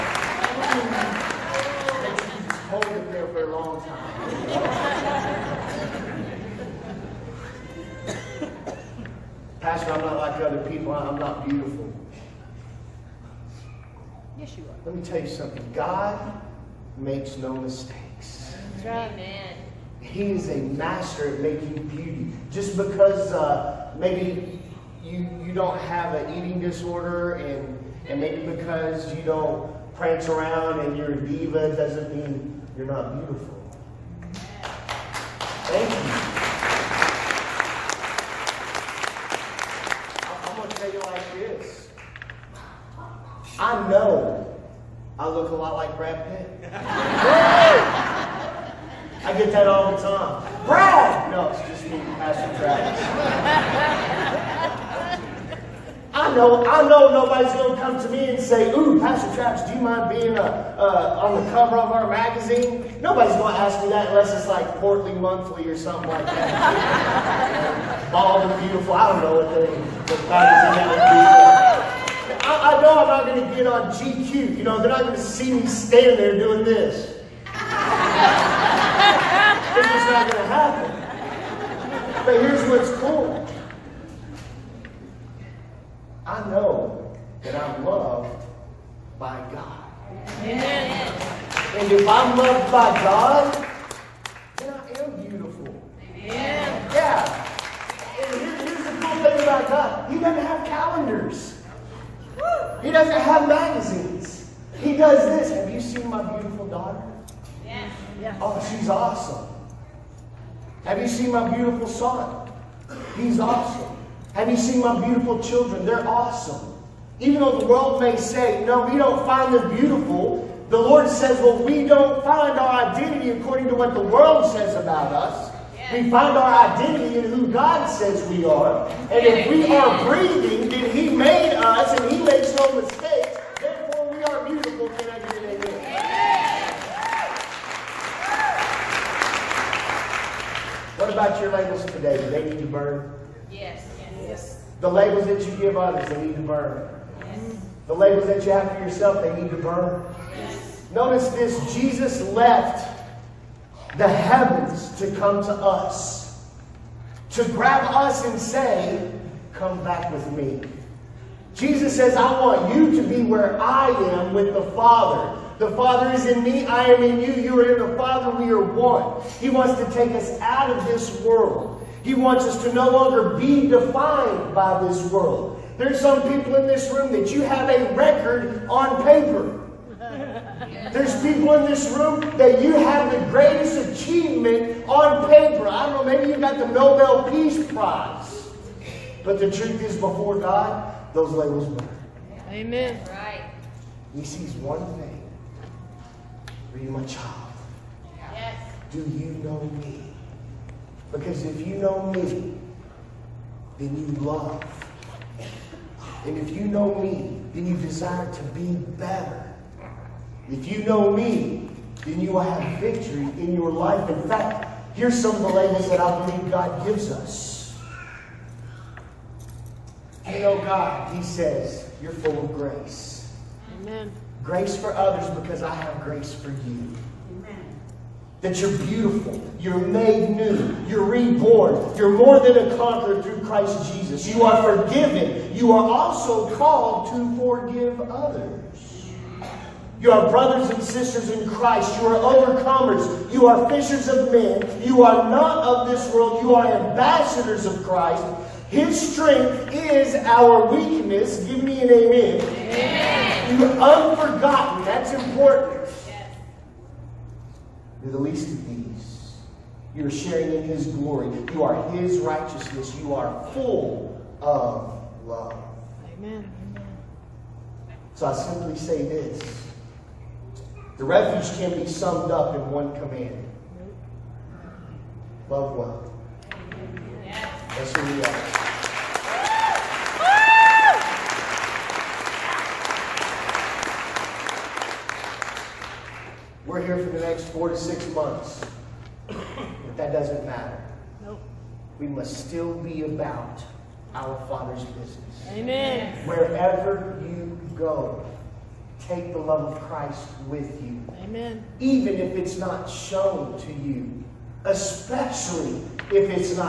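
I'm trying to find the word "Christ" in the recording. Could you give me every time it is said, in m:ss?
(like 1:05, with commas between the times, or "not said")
3:53, 4:01, 4:07, 4:59.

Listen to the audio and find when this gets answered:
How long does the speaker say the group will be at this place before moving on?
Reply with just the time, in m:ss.
4:47.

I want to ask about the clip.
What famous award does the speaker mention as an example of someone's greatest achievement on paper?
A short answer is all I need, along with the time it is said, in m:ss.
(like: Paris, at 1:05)
Nobel Peace Prize, at 3:06.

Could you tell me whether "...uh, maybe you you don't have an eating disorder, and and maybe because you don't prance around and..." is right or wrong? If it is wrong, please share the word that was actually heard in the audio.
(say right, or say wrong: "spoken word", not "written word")
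right.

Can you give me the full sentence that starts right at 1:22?
But here's what's cool I know that I'm loved by God.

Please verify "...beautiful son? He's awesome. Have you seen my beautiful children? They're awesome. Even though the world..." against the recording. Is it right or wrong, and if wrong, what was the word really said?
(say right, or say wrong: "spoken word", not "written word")
right.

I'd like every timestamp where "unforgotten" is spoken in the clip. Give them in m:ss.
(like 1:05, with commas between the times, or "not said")
4:13.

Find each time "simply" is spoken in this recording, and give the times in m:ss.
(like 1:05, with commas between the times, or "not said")
4:28.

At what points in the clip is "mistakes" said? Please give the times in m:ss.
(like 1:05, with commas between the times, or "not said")
0:17, 2:12.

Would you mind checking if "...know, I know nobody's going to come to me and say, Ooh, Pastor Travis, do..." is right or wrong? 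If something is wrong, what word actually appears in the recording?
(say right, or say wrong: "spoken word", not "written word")
right.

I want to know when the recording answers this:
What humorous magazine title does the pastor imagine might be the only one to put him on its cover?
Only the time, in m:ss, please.
1:04.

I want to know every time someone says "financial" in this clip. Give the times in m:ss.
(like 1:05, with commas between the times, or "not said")
not said.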